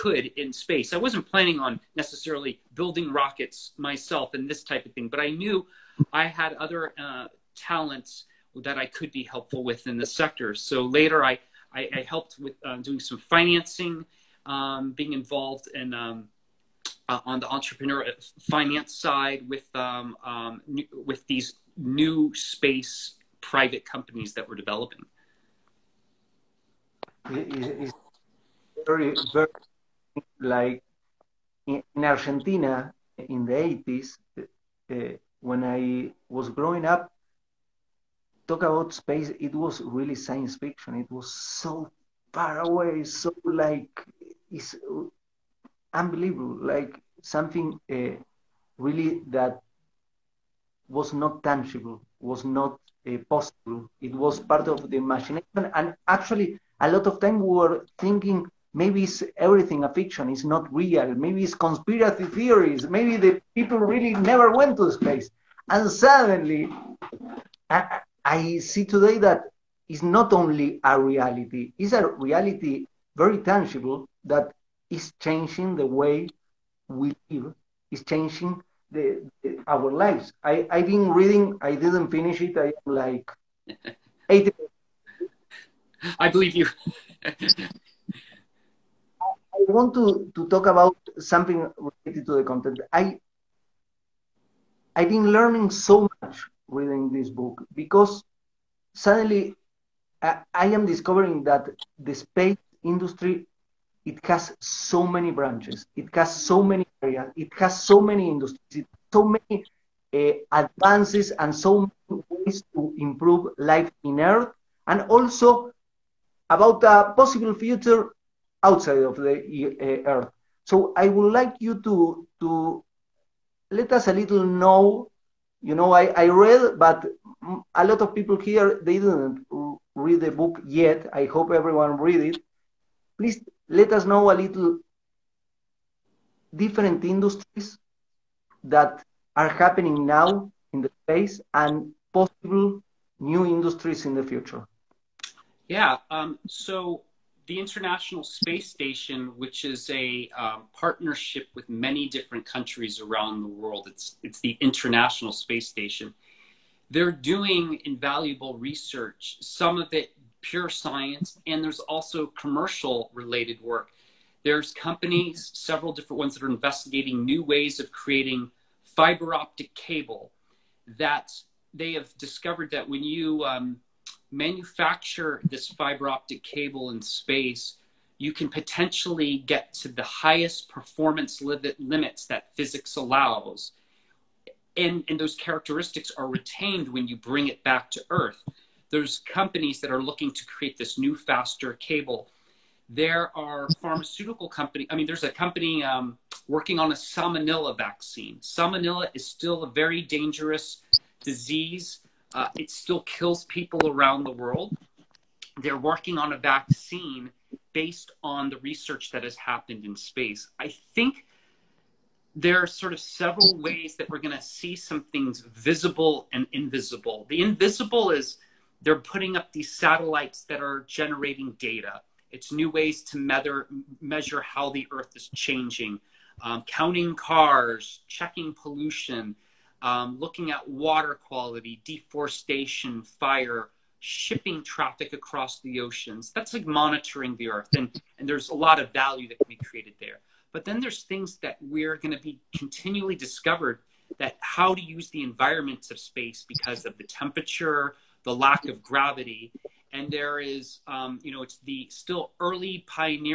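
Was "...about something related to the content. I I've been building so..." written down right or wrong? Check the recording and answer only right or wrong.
wrong.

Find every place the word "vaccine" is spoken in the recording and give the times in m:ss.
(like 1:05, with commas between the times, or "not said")
3:17, 3:26.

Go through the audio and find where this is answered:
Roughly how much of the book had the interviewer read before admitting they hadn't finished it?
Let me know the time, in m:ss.
1:24.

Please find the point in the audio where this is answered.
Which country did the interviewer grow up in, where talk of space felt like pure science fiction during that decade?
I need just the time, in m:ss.
0:32.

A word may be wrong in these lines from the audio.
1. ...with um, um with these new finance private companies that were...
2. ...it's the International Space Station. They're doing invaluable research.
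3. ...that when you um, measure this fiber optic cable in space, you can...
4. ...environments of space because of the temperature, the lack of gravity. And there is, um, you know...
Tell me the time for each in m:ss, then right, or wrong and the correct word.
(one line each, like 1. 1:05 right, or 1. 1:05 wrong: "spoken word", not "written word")
1. 0:19 wrong: "space", not "finance"
2. 2:34 right
3. 2:52 wrong: "manufacture", not "measure"
4. 4:05 right.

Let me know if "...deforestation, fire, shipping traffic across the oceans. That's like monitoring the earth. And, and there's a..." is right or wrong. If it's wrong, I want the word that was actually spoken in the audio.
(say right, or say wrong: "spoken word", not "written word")
right.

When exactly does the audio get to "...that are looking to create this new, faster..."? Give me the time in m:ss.
3:09.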